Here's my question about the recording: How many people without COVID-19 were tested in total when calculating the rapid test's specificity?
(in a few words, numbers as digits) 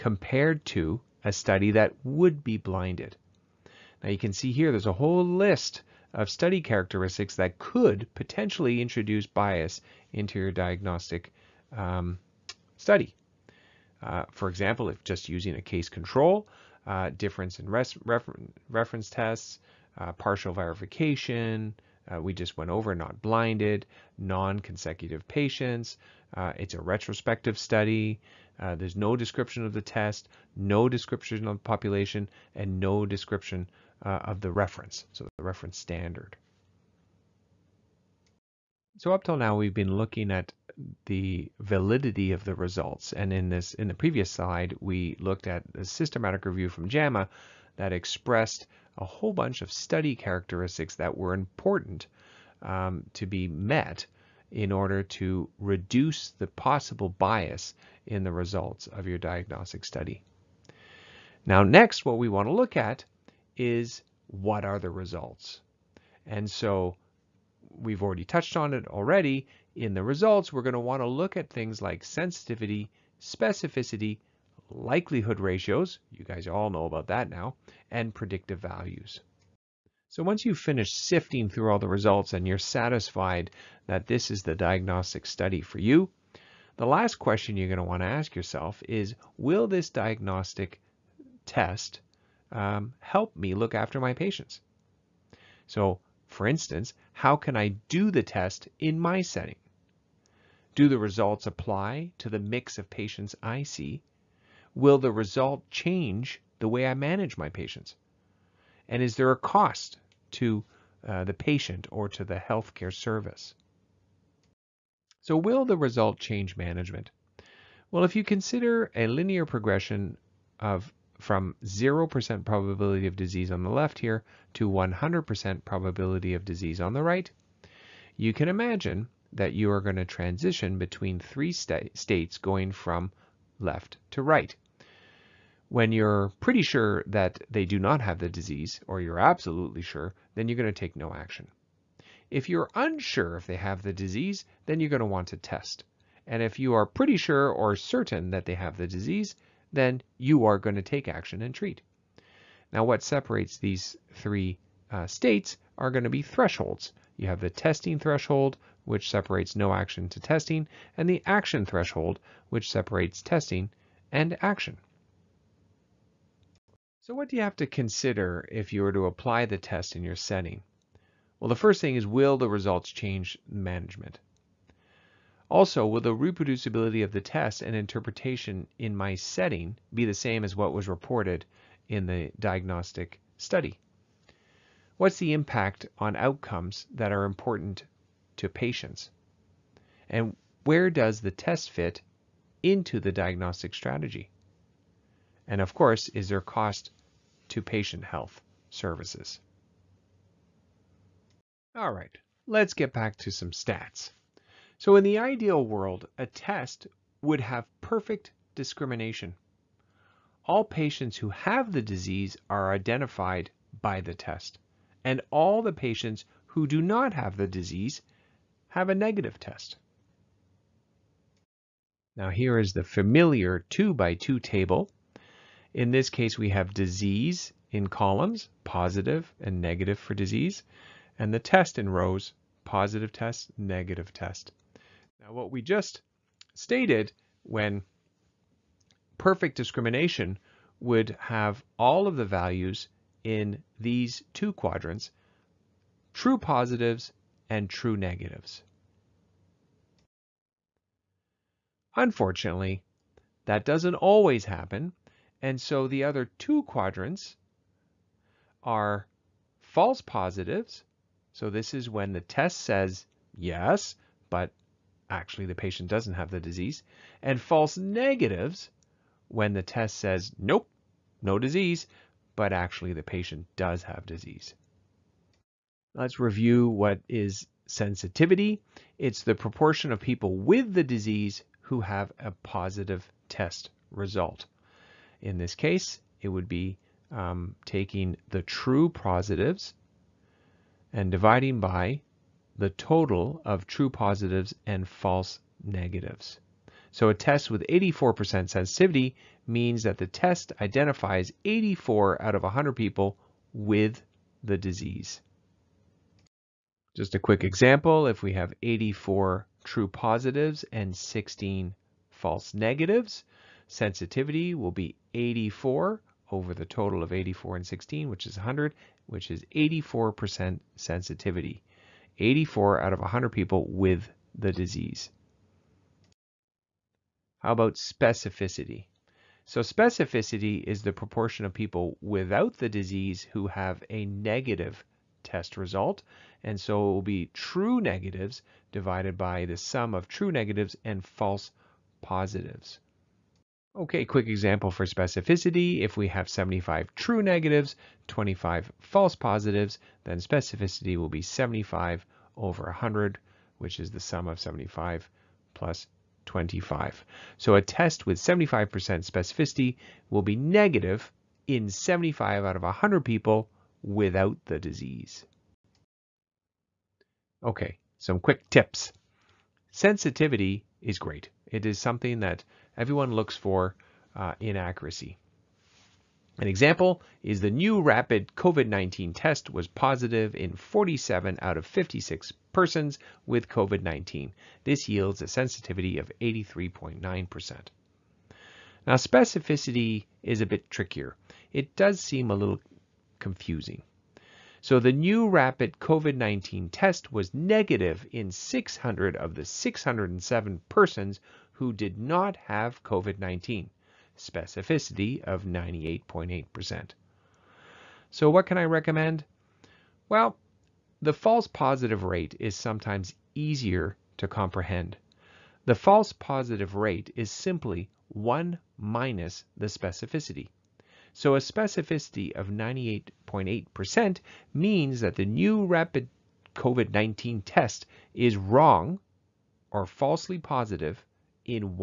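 607.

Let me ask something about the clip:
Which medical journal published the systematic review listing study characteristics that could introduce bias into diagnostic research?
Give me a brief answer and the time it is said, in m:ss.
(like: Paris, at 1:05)
JAMA, at 0:46.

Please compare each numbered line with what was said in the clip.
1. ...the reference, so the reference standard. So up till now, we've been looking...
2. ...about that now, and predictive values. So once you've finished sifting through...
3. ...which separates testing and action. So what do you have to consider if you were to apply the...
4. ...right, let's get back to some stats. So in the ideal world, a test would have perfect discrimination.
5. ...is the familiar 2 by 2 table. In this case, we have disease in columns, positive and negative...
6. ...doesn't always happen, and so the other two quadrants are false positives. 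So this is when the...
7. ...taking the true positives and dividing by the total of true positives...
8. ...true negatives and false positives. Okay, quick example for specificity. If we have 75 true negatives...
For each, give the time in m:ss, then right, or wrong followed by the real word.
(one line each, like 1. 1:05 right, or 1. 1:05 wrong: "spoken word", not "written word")
1. 0:34 right
2. 1:16 right
3. 2:42 right
4. 3:21 right
5. 3:42 right
6. 4:13 right
7. 4:47 right
8. 5:40 right.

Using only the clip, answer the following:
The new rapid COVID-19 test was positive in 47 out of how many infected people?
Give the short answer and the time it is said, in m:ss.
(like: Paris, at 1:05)
56, at 6:21.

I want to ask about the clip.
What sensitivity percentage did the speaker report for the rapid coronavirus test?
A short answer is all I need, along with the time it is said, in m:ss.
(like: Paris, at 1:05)
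83.9%, at 6:26.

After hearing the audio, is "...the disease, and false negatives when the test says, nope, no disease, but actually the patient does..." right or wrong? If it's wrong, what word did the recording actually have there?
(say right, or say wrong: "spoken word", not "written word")
right.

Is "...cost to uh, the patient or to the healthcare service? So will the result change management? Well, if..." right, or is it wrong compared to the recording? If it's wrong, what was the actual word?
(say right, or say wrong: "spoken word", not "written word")
right.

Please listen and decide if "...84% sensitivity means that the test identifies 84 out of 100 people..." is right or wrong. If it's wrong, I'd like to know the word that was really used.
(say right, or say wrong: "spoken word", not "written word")
right.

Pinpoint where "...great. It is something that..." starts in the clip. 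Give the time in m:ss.
6:10.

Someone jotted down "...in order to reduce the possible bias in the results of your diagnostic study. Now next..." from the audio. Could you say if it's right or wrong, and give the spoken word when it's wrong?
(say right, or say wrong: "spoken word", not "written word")
right.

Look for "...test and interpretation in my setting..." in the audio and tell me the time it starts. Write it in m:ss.
2:57.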